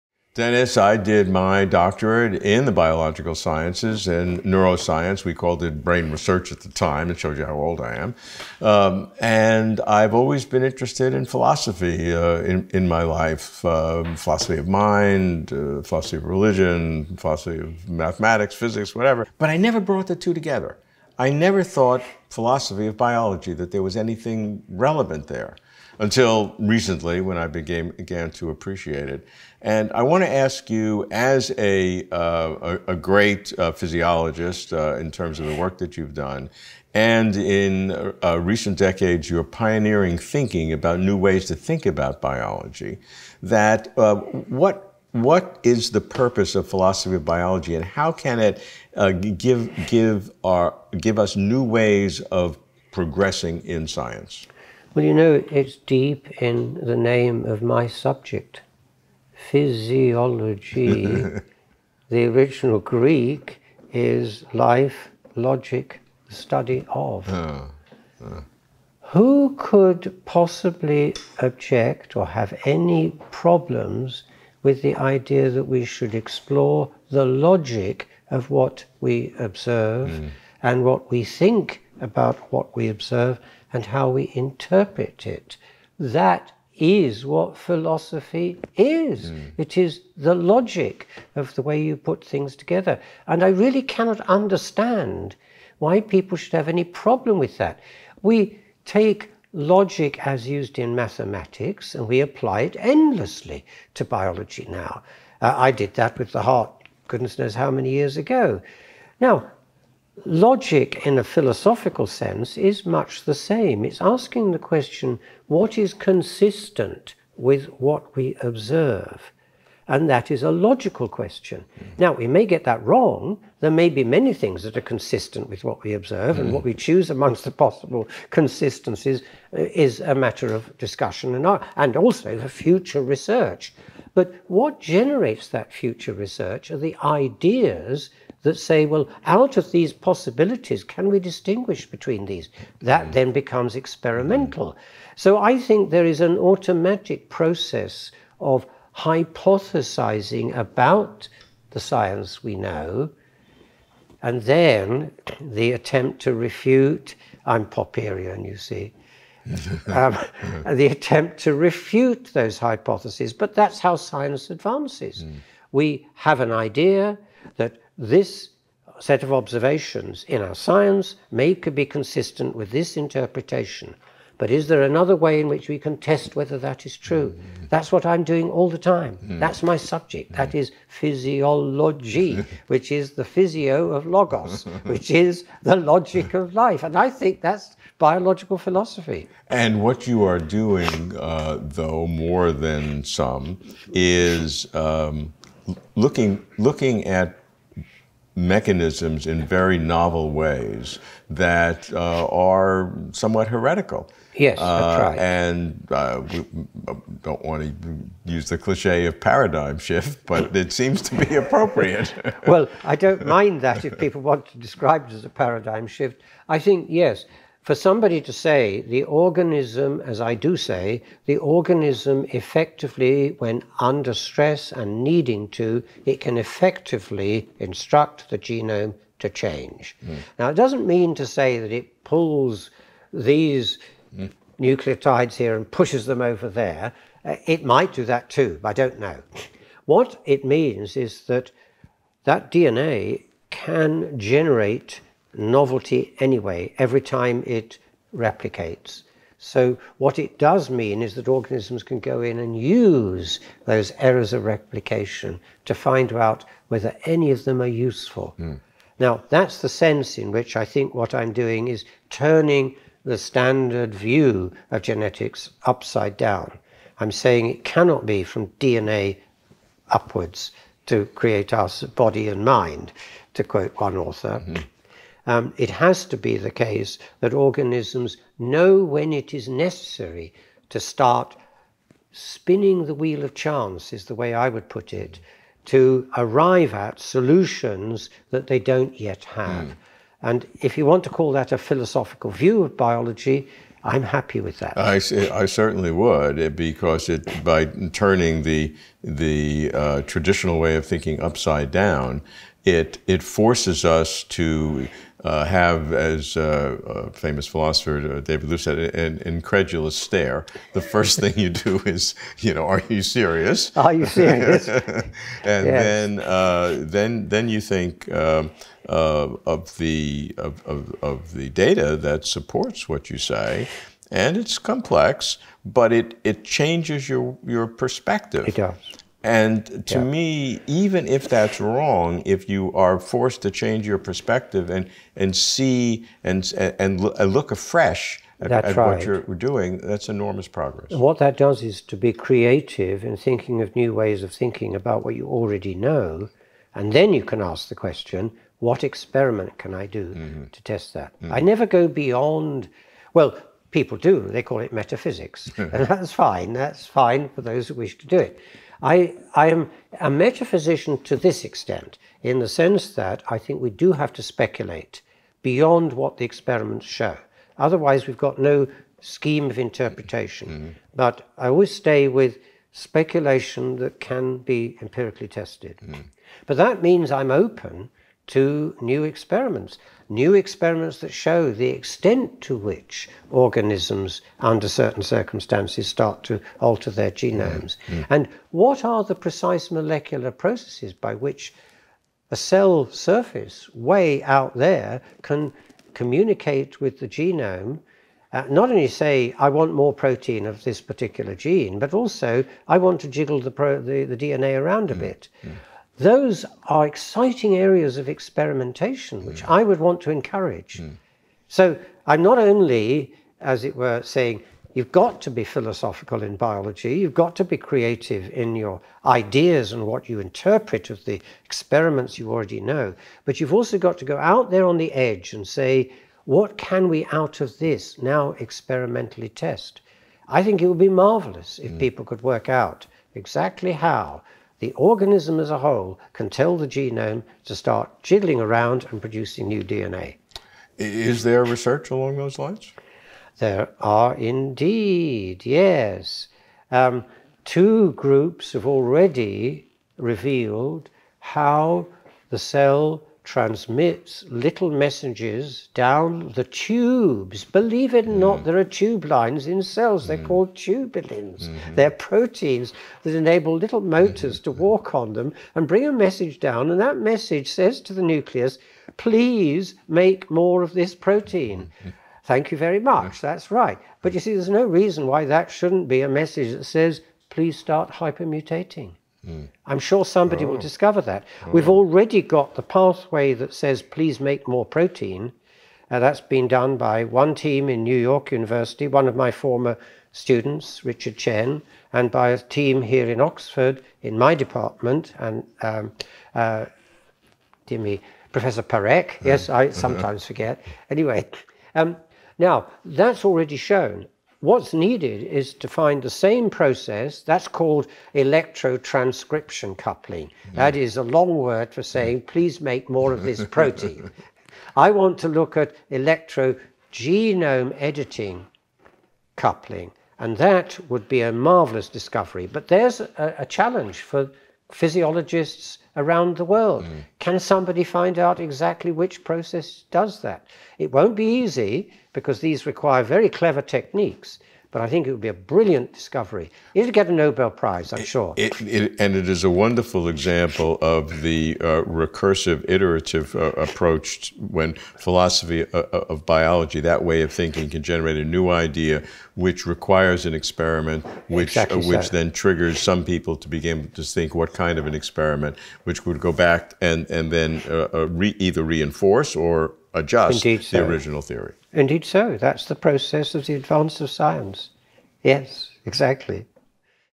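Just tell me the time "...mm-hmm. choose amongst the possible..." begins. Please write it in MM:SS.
02:06.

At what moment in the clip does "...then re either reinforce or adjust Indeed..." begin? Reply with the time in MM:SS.
09:17.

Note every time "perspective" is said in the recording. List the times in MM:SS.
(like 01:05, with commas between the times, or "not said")
05:27, 05:33.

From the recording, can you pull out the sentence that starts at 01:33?
And I really cannot understand why people should have any problem with that.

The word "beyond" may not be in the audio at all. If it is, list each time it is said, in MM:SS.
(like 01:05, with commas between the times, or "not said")
05:51, 06:05.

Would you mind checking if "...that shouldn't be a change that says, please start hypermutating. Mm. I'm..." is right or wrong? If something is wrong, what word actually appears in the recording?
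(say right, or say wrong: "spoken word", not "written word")
wrong: "message", not "change".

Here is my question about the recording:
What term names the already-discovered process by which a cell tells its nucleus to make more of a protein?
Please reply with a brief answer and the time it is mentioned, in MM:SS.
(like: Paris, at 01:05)
Electrotranscription coupling, at 08:28.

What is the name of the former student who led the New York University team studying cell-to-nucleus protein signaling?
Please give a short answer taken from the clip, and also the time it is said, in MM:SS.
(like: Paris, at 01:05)
Richard Tsien, at 08:10.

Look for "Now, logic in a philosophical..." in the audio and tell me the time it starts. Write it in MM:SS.
01:49.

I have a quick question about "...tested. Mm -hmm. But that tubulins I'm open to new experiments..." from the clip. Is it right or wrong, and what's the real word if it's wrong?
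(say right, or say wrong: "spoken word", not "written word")
wrong: "means", not "tubulins".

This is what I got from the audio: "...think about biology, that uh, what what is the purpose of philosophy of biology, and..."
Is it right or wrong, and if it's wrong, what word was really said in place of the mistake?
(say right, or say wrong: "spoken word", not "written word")
right.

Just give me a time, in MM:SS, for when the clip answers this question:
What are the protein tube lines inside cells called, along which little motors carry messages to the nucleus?
07:40.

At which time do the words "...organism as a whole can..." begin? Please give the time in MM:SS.
07:14.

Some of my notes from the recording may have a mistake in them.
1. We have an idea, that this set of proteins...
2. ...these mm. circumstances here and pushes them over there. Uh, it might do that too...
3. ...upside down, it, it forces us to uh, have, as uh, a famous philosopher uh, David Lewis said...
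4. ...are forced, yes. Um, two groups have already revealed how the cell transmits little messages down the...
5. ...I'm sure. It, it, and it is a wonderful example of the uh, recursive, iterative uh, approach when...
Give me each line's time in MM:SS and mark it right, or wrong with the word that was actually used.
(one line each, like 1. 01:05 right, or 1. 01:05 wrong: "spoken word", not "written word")
1. 02:45 wrong: "observations", not "proteins"
2. 03:53 wrong: "nucleotides", not "circumstances"
3. 05:01 right
4. 07:23 wrong: "indeed", not "forced"
5. 08:57 right.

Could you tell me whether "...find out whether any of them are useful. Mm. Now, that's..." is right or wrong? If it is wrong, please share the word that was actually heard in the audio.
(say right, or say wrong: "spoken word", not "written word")
right.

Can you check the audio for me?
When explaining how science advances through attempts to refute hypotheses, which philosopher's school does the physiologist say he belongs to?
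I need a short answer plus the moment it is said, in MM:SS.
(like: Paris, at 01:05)
Popperian, at 02:37.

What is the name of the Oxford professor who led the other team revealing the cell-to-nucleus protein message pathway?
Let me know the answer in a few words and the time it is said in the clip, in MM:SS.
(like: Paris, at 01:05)
Professor Parekh, at 08:18.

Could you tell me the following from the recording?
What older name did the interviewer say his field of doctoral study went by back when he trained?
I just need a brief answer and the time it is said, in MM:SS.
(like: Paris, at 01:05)
Brain research, at 00:05.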